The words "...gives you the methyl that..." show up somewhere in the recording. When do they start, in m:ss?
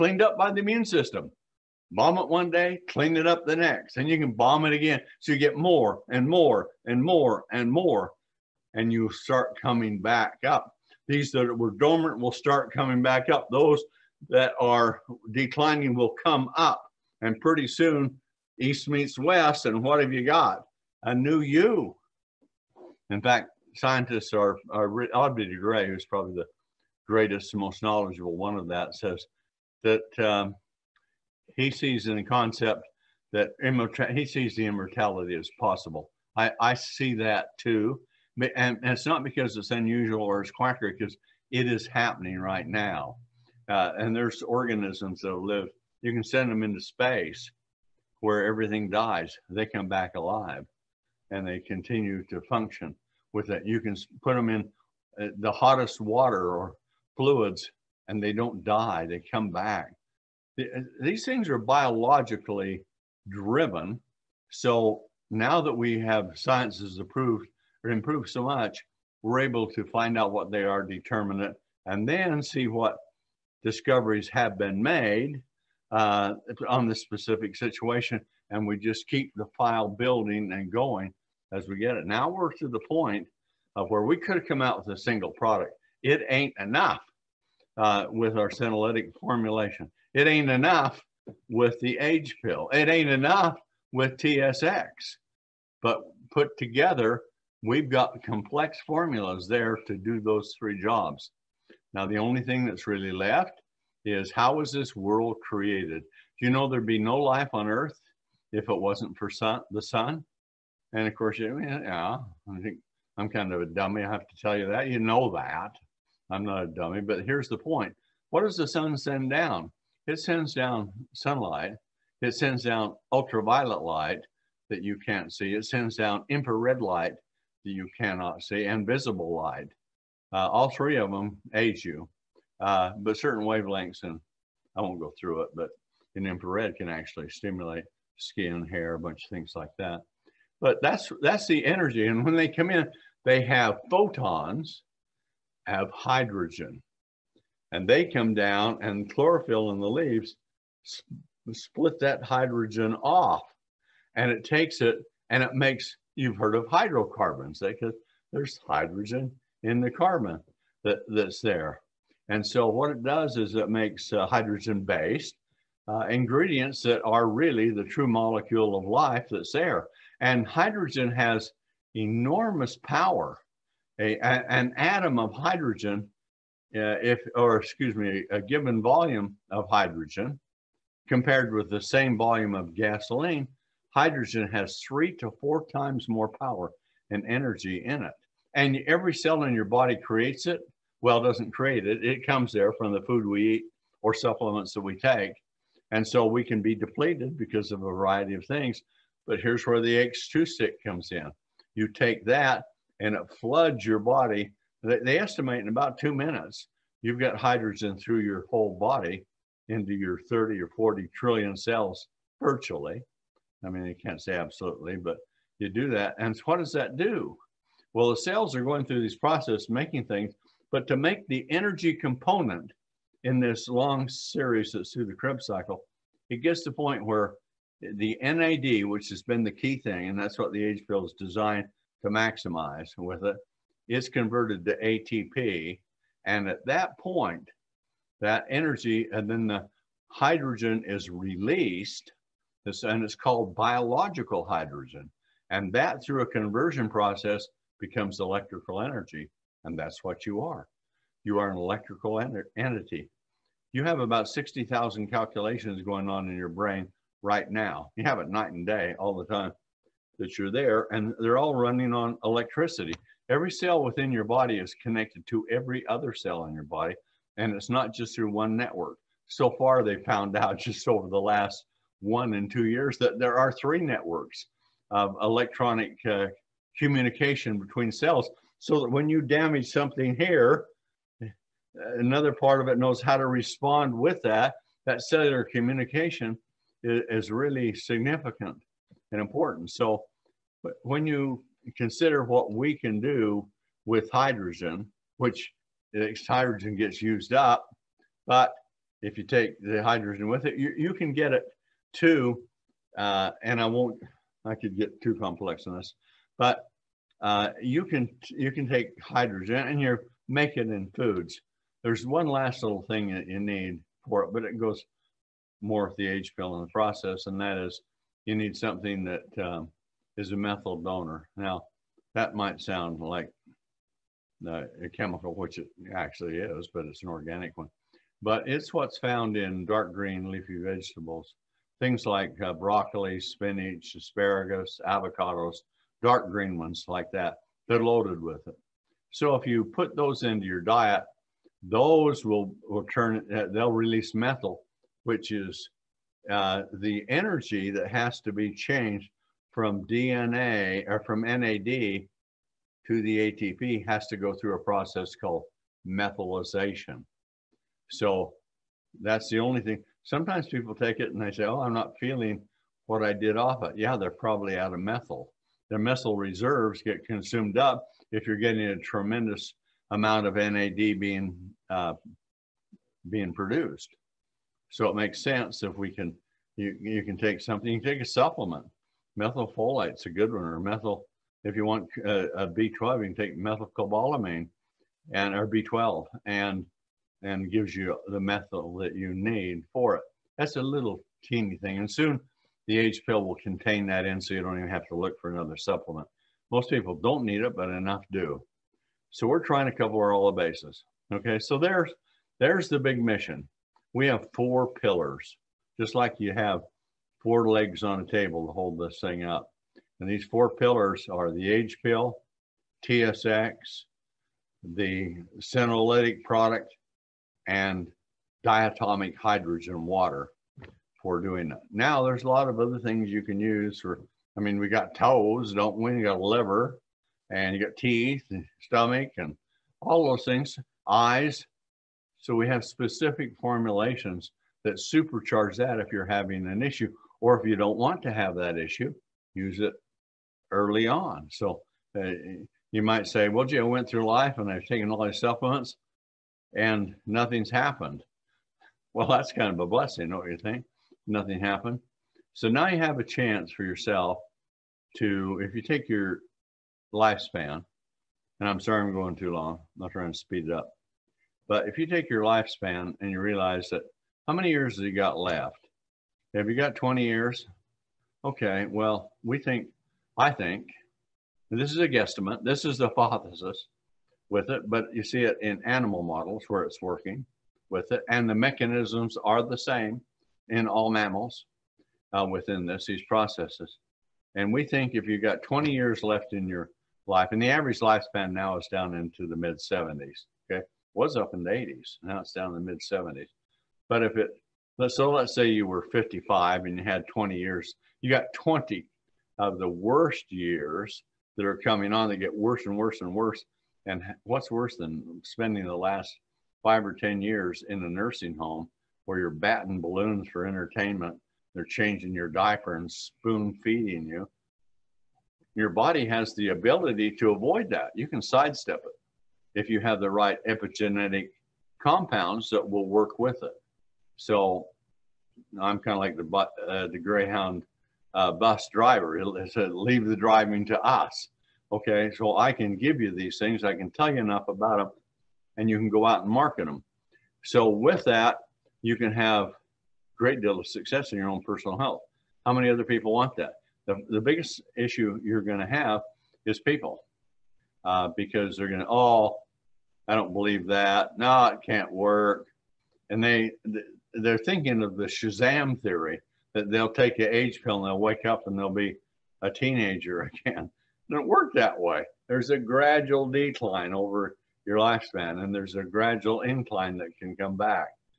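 6:27.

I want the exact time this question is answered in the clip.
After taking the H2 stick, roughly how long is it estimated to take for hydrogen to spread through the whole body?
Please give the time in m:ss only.
3:25.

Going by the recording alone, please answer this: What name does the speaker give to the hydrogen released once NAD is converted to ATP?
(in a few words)
biological hydrogen.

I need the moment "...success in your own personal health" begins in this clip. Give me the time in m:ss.
9:00.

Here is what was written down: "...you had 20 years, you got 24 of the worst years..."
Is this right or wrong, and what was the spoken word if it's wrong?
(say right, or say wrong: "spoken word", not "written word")
wrong: "20", not "24".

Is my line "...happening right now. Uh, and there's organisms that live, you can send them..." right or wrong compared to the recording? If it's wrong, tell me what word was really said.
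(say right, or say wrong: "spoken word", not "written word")
right.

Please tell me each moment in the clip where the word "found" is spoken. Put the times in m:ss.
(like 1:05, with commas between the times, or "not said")
4:30, 5:28.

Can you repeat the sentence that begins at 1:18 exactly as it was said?
And we just keep the file building and going as we get it.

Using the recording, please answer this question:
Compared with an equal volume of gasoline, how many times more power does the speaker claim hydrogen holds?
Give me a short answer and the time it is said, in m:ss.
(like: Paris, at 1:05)
3 to 4 times, at 3:04.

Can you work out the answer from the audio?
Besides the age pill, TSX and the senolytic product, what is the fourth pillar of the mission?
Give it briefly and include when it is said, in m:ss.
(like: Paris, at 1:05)
diatomic hydrogen water, at 6:58.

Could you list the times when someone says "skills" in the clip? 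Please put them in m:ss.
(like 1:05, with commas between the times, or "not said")
not said.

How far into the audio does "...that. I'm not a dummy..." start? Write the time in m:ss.
1:55.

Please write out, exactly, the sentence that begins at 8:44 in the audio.
So I'm kind of like the uh, the Greyhound uh, bus driver.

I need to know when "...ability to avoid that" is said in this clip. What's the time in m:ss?
8:36.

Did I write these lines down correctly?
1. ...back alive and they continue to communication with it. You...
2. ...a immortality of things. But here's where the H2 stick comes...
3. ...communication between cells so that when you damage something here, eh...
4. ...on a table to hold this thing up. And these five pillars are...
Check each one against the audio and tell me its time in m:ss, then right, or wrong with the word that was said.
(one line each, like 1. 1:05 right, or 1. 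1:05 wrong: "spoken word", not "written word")
1. 0:49 wrong: "function", not "communication"
2. 3:17 wrong: "variety", not "immortality"
3. 4:36 right
4. 6:47 wrong: "four", not "five".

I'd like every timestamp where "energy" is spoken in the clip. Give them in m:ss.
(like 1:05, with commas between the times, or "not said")
2:21, 3:07, 3:41, 3:58, 4:08, 5:47.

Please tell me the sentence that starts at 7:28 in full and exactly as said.
Well, that's kind of a blessing, don't you think?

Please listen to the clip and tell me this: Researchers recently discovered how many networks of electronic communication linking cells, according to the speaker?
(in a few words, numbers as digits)
3.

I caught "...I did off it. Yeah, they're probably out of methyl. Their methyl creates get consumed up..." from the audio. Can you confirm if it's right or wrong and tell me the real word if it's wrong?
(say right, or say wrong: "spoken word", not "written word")
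wrong: "reserves", not "creates".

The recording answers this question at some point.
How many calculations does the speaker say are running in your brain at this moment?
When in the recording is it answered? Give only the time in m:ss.
4:14.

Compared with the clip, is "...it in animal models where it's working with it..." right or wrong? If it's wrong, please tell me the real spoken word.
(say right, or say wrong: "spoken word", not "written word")
right.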